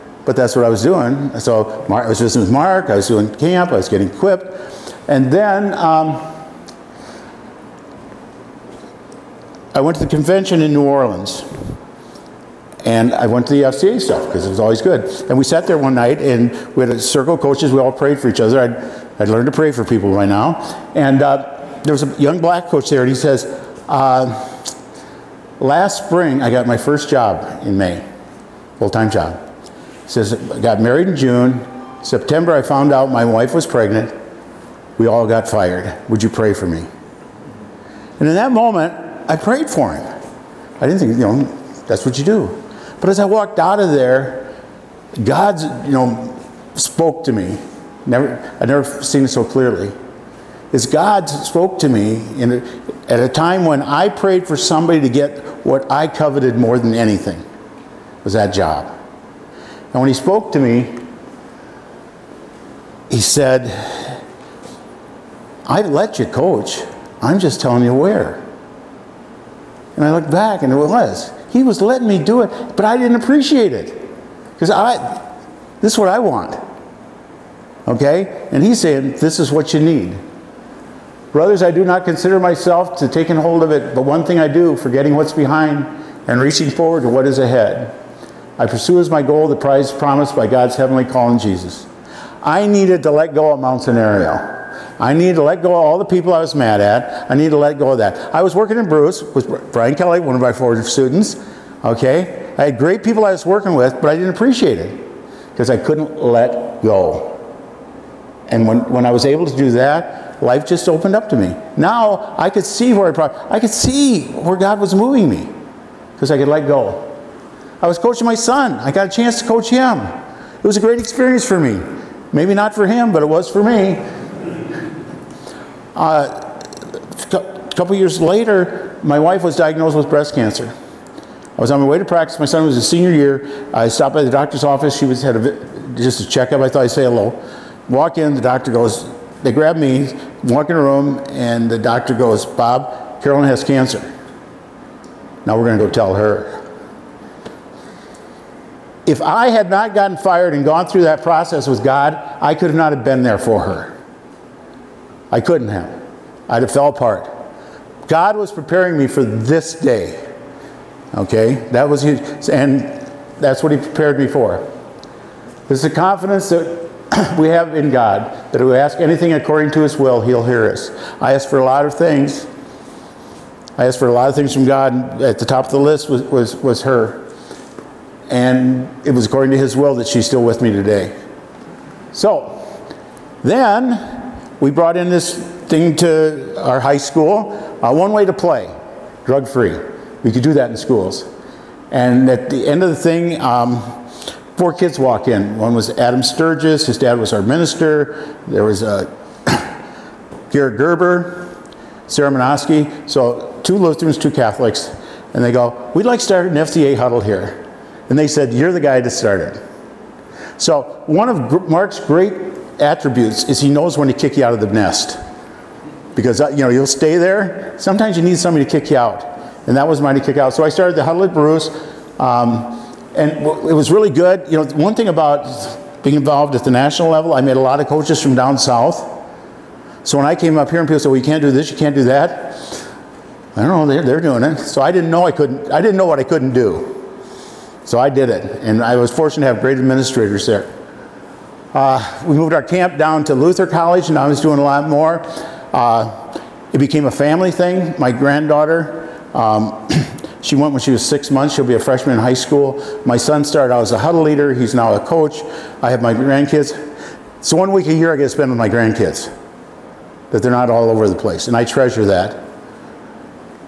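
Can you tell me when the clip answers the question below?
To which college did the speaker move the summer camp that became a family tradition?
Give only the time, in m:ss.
4:03.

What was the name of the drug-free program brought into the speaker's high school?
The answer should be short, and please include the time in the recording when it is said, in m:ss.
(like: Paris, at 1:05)
One Way to Play, at 3:07.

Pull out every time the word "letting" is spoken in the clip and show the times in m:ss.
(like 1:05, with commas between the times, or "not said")
1:11.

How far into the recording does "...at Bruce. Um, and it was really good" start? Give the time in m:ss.
3:41.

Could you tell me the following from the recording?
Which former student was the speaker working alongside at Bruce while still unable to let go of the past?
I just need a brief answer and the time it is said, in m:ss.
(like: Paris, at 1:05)
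Brian Kelly, at 1:39.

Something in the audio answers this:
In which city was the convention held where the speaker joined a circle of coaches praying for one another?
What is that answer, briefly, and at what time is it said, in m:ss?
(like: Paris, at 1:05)
New Orleans, at 0:10.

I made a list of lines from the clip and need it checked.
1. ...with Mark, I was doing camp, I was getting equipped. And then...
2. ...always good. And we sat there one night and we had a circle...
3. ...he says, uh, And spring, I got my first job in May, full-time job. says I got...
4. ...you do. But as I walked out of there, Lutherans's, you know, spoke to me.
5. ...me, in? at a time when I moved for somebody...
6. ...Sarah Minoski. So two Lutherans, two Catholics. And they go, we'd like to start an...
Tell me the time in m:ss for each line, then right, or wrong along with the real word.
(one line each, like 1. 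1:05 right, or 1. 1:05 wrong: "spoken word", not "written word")
1. 0:02 right
2. 0:14 right
3. 0:23 wrong: "Last", not "And"
4. 0:42 wrong: "God", not "Lutherans"
5. 0:51 wrong: "prayed", not "moved"
6. 3:22 right.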